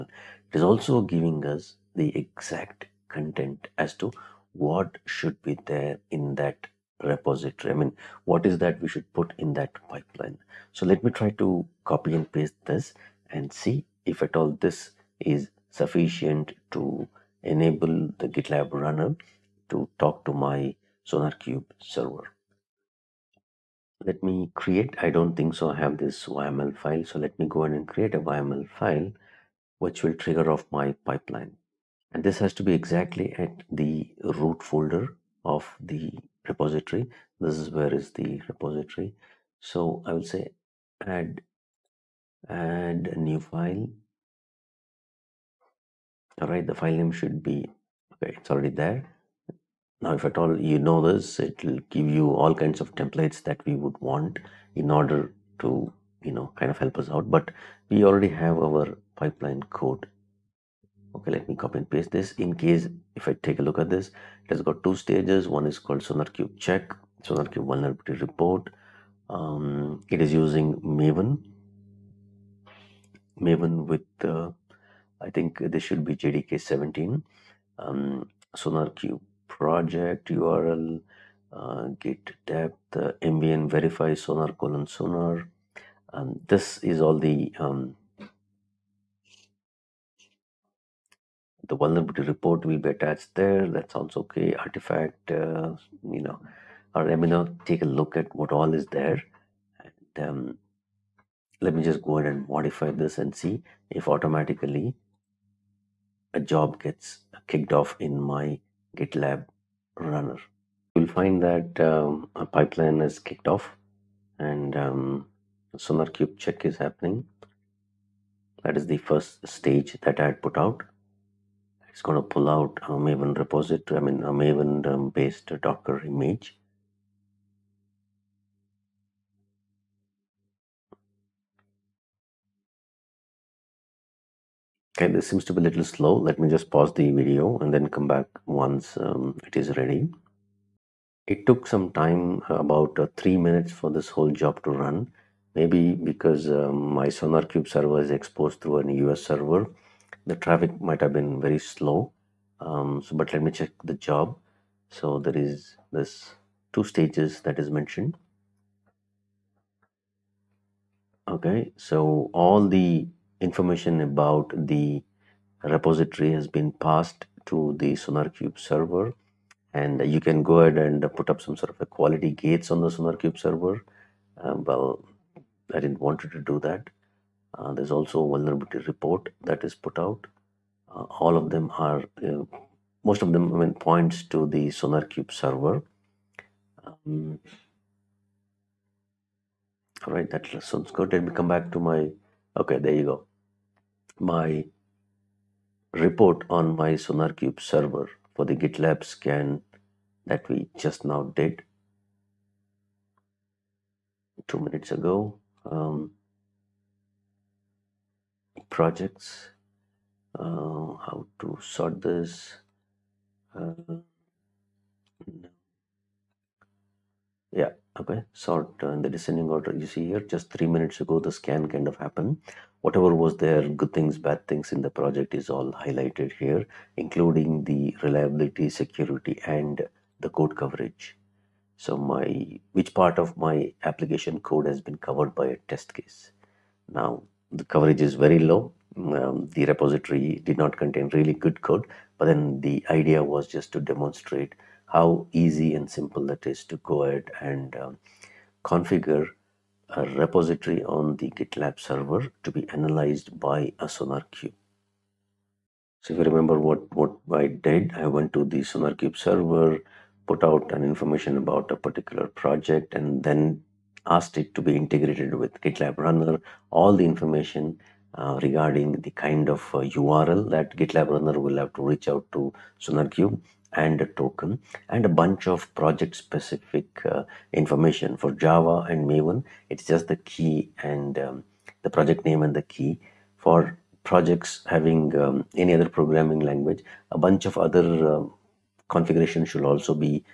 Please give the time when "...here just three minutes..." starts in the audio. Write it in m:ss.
3:40.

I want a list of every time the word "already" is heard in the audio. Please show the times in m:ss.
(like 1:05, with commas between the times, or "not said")
0:48, 0:58.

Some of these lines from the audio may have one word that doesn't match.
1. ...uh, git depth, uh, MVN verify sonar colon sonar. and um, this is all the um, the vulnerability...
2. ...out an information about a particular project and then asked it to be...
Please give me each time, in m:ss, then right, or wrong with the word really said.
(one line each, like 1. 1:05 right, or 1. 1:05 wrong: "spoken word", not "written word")
1. 1:21 right
2. 4:20 right.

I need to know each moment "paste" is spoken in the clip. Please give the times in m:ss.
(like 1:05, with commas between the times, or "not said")
0:12, 1:01.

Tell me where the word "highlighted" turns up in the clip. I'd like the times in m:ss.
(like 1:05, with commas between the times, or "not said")
3:45.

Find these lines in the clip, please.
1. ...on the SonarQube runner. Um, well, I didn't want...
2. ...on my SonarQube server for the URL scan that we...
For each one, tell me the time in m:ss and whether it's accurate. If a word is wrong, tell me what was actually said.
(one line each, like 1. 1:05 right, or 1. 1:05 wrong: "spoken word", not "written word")
1. 2:52 wrong: "server", not "runner"
2. 3:16 wrong: "GitLab", not "URL".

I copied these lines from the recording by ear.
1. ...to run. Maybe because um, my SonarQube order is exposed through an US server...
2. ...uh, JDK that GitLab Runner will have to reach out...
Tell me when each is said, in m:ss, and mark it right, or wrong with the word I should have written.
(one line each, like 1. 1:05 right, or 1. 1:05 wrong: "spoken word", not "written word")
1. 2:24 wrong: "server", not "order"
2. 4:29 wrong: "URL", not "JDK".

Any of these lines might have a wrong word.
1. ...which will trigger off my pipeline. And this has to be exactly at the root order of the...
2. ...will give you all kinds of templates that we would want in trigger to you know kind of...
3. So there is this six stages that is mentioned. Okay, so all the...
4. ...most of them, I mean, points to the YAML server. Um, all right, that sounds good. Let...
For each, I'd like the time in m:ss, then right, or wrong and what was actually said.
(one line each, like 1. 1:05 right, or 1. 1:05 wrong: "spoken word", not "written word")
1. 0:29 wrong: "folder", not "order"
2. 0:51 wrong: "order", not "trigger"
3. 2:34 wrong: "two", not "six"
4. 3:03 wrong: "SonarQube", not "YAML".